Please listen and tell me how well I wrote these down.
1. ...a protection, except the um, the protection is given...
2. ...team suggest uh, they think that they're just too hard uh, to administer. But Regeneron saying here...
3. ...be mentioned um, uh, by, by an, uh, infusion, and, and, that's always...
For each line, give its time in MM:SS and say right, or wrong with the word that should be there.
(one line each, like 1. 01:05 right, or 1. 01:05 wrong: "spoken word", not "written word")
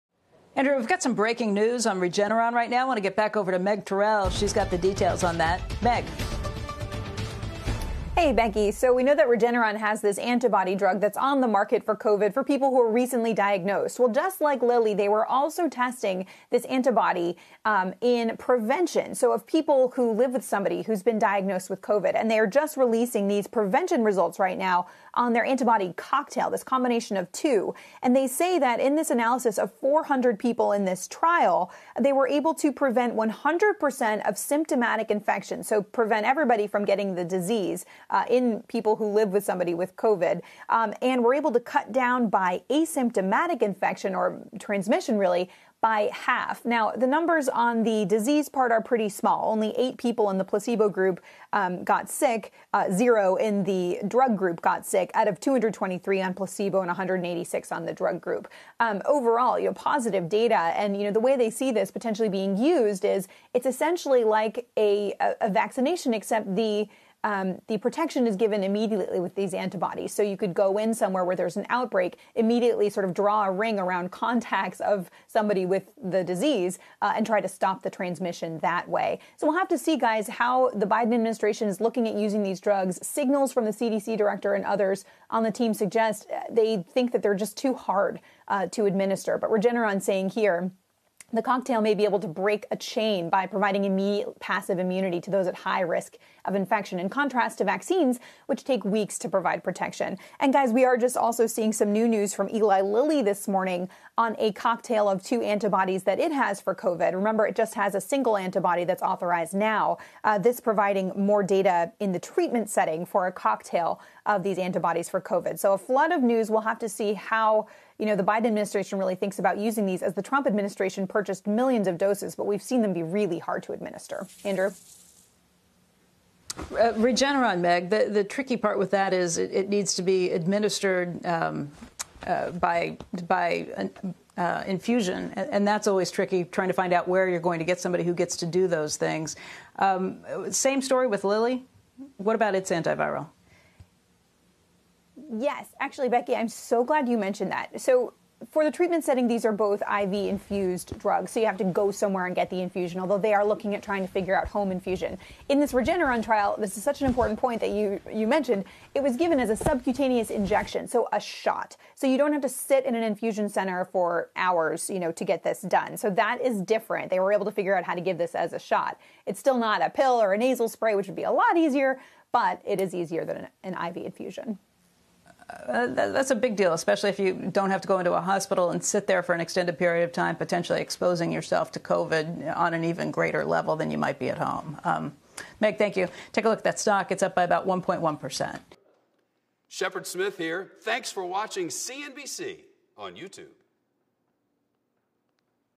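1. 01:05 wrong: "vaccination", not "protection"
2. 01:25 right
3. 02:10 wrong: "administered", not "mentioned".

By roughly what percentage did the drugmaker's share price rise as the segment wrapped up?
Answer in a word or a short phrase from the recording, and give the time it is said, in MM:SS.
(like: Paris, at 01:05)
1.1%, at 03:07.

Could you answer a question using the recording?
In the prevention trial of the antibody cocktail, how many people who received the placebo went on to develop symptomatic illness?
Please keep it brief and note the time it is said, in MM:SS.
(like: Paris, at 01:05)
8, at 00:49.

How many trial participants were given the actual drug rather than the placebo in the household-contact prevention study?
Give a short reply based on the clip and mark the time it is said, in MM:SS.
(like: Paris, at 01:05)
186, at 00:56.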